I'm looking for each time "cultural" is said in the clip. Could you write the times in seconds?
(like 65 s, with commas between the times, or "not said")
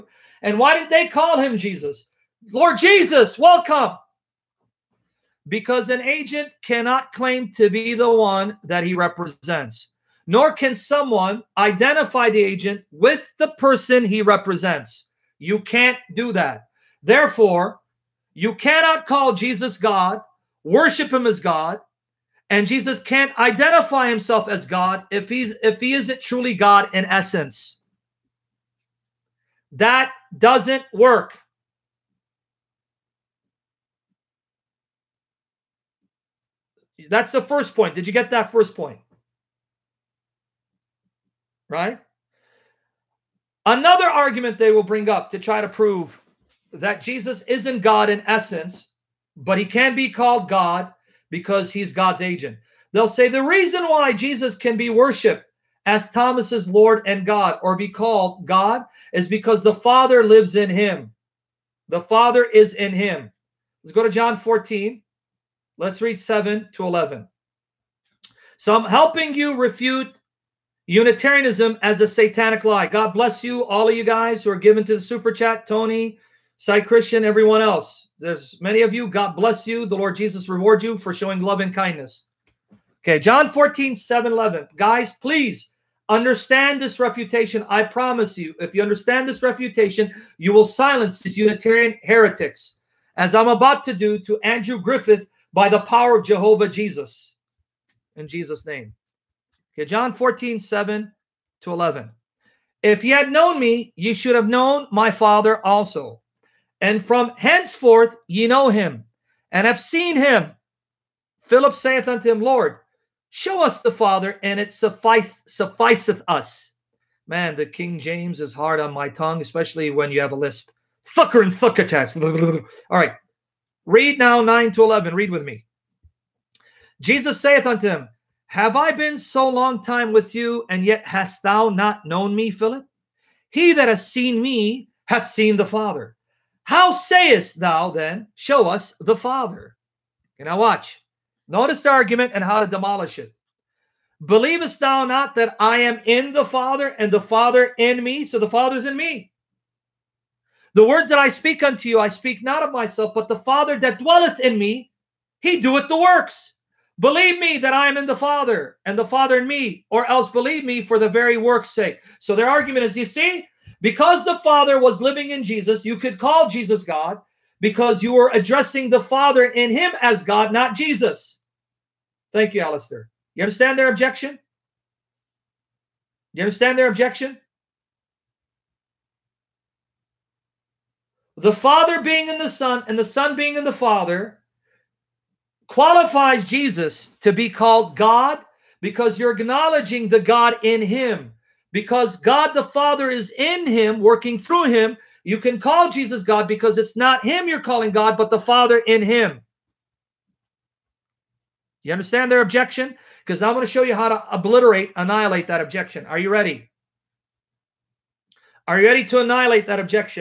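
not said.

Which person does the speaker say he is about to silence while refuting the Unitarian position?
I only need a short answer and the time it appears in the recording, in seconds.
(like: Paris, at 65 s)
Andrew Griffith, at 94 s.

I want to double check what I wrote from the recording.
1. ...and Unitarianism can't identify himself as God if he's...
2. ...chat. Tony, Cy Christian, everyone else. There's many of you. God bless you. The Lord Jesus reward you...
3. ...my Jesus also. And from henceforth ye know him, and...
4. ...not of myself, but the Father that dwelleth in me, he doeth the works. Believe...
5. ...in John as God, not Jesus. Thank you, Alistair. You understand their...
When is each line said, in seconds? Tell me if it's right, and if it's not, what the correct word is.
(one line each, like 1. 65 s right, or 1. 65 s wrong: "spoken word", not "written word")
1. 22 s wrong: "Jesus", not "Unitarianism"
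2. 75 s right
3. 104 s wrong: "Father", not "Jesus"
4. 152 s right
5. 169 s wrong: "Him", not "John".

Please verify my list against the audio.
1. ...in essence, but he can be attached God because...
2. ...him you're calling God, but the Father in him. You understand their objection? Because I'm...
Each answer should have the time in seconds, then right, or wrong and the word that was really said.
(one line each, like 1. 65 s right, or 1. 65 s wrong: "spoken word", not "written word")
1. 48 s wrong: "called", not "attached"
2. 197 s right.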